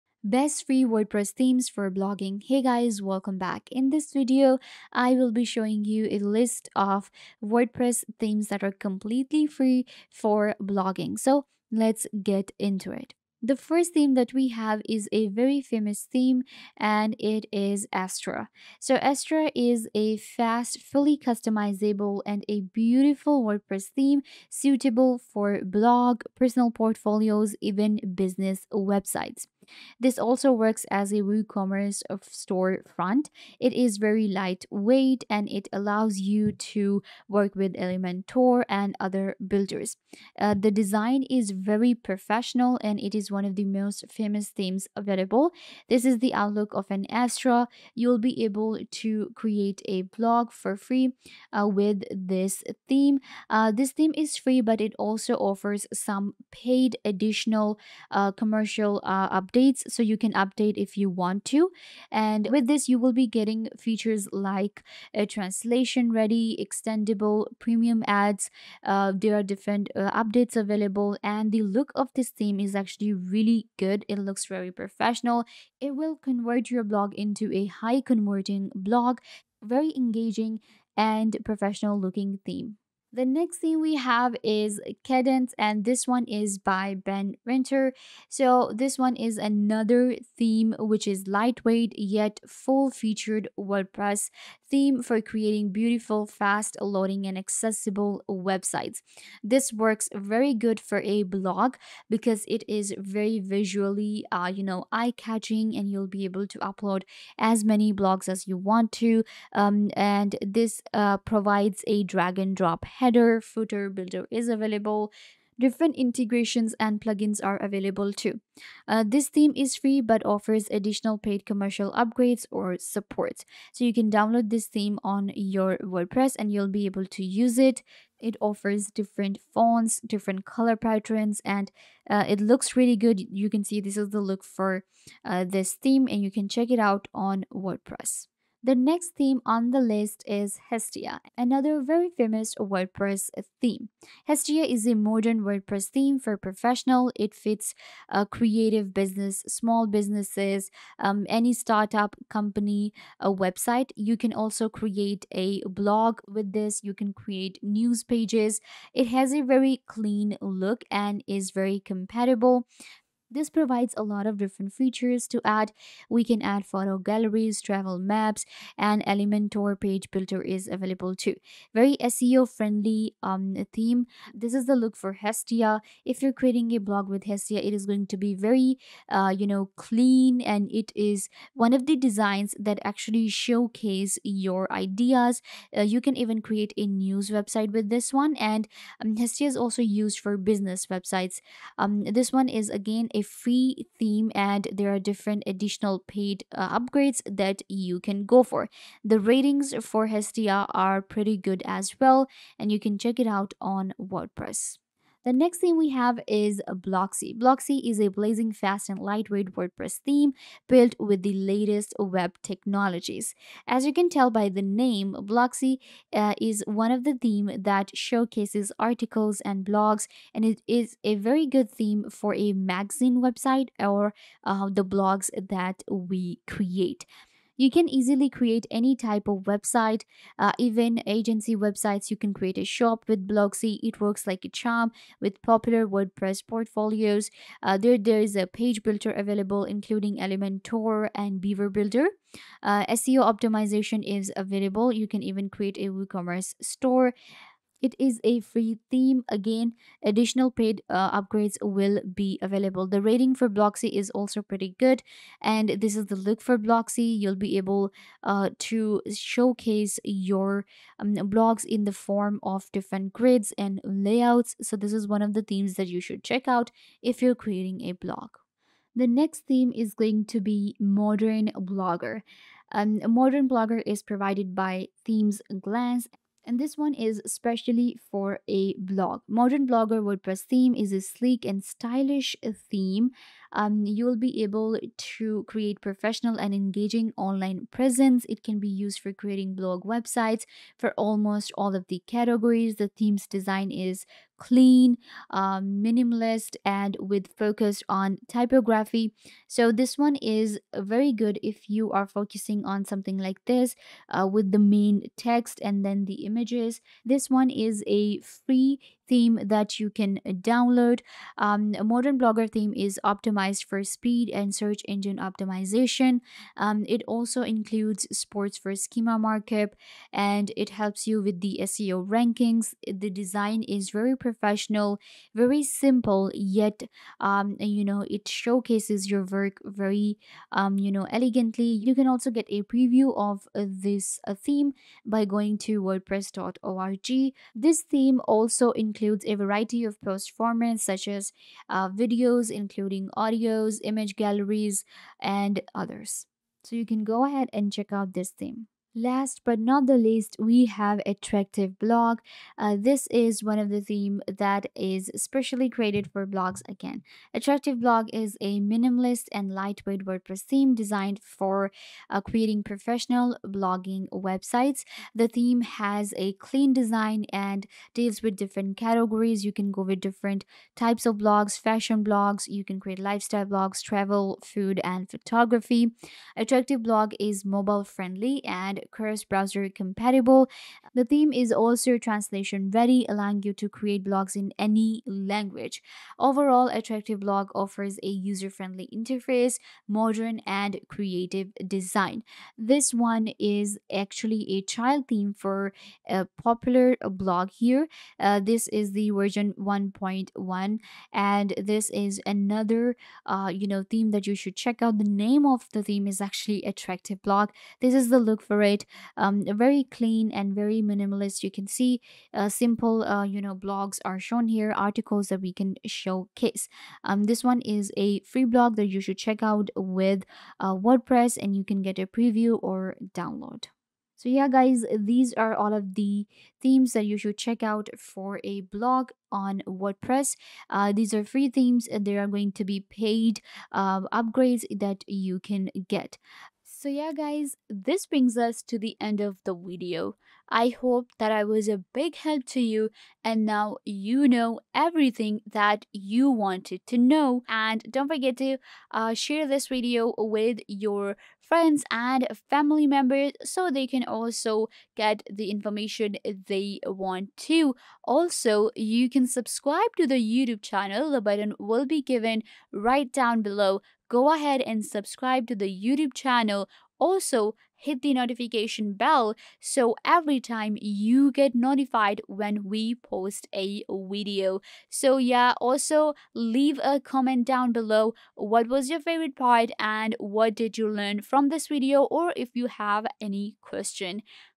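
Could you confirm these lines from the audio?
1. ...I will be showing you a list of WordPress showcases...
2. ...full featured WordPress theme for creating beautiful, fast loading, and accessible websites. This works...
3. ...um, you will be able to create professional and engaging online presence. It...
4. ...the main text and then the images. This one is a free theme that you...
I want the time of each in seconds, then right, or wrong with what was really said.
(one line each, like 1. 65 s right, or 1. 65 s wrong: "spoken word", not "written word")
1. 4 s wrong: "themes", not "showcases"
2. 92 s right
3. 283 s right
4. 304 s right.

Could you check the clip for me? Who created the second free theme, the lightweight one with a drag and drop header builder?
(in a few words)
Ben Ritner.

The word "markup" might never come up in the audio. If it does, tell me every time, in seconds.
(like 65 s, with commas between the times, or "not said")
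319 s.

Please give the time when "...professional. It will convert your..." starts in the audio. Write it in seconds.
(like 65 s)
74 s.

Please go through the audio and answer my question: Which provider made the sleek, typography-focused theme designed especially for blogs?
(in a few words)
Themes Glance.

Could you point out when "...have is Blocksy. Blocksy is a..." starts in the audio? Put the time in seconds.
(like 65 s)
205 s.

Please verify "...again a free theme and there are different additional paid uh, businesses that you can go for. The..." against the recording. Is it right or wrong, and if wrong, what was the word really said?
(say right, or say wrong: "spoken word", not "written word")
wrong: "upgrades", not "businesses".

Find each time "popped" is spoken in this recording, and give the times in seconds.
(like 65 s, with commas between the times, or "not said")
not said.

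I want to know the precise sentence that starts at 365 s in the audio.
The theme has a clean design and deals with different categories.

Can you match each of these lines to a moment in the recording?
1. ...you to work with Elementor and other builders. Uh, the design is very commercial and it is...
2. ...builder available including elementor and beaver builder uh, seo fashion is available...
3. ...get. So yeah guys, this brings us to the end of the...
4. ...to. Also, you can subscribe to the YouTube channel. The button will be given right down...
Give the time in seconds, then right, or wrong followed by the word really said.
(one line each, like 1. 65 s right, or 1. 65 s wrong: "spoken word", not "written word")
1. 36 s wrong: "professional", not "commercial"
2. 238 s wrong: "optimization", not "fashion"
3. 435 s right
4. 457 s right.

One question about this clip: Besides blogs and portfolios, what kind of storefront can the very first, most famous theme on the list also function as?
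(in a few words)
WooCommerce storefront.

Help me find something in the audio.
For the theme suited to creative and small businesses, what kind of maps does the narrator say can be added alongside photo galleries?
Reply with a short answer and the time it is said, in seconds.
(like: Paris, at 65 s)
Travel maps, at 167 s.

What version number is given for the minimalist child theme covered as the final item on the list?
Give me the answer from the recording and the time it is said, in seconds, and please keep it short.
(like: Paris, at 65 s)
1.1, at 399 s.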